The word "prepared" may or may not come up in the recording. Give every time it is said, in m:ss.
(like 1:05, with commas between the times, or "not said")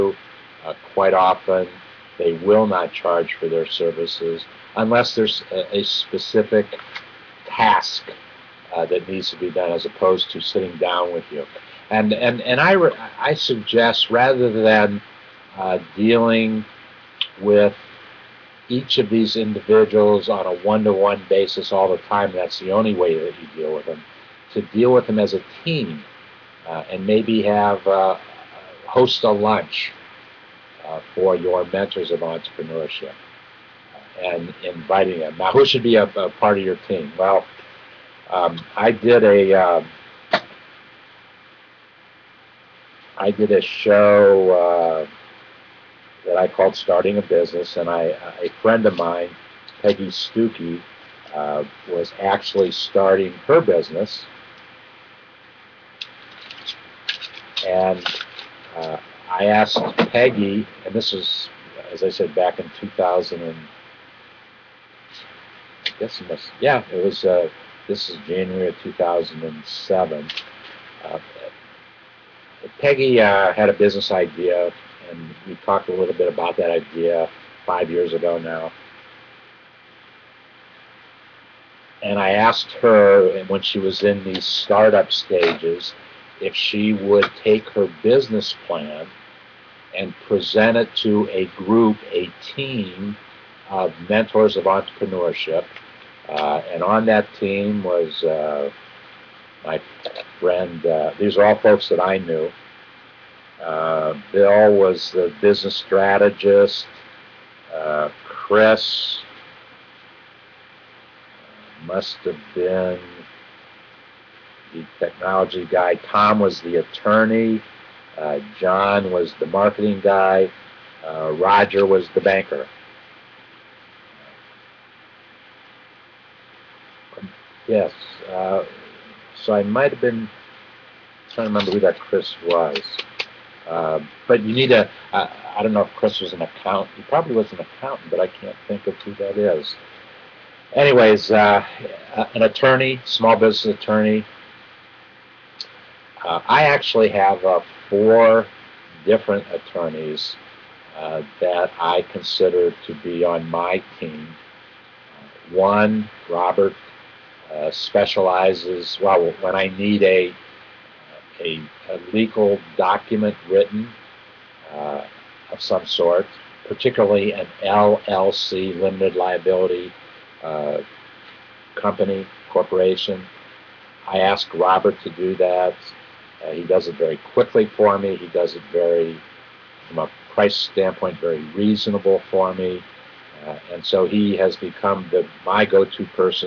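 not said.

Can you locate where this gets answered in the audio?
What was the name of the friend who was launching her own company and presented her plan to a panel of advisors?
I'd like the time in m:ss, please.
0:49.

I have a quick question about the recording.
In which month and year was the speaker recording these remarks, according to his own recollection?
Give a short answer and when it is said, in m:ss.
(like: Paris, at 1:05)
January 2007, at 1:08.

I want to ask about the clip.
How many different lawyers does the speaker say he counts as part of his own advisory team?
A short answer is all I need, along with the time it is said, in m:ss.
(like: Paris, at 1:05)
4, at 2:27.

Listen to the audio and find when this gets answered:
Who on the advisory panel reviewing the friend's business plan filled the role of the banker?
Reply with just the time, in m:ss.
2:01.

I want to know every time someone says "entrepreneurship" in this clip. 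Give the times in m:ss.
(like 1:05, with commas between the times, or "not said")
0:32, 1:34.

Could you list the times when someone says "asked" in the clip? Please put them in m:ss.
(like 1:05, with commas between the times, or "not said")
0:59, 1:22.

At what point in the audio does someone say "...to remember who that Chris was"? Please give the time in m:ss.
2:11.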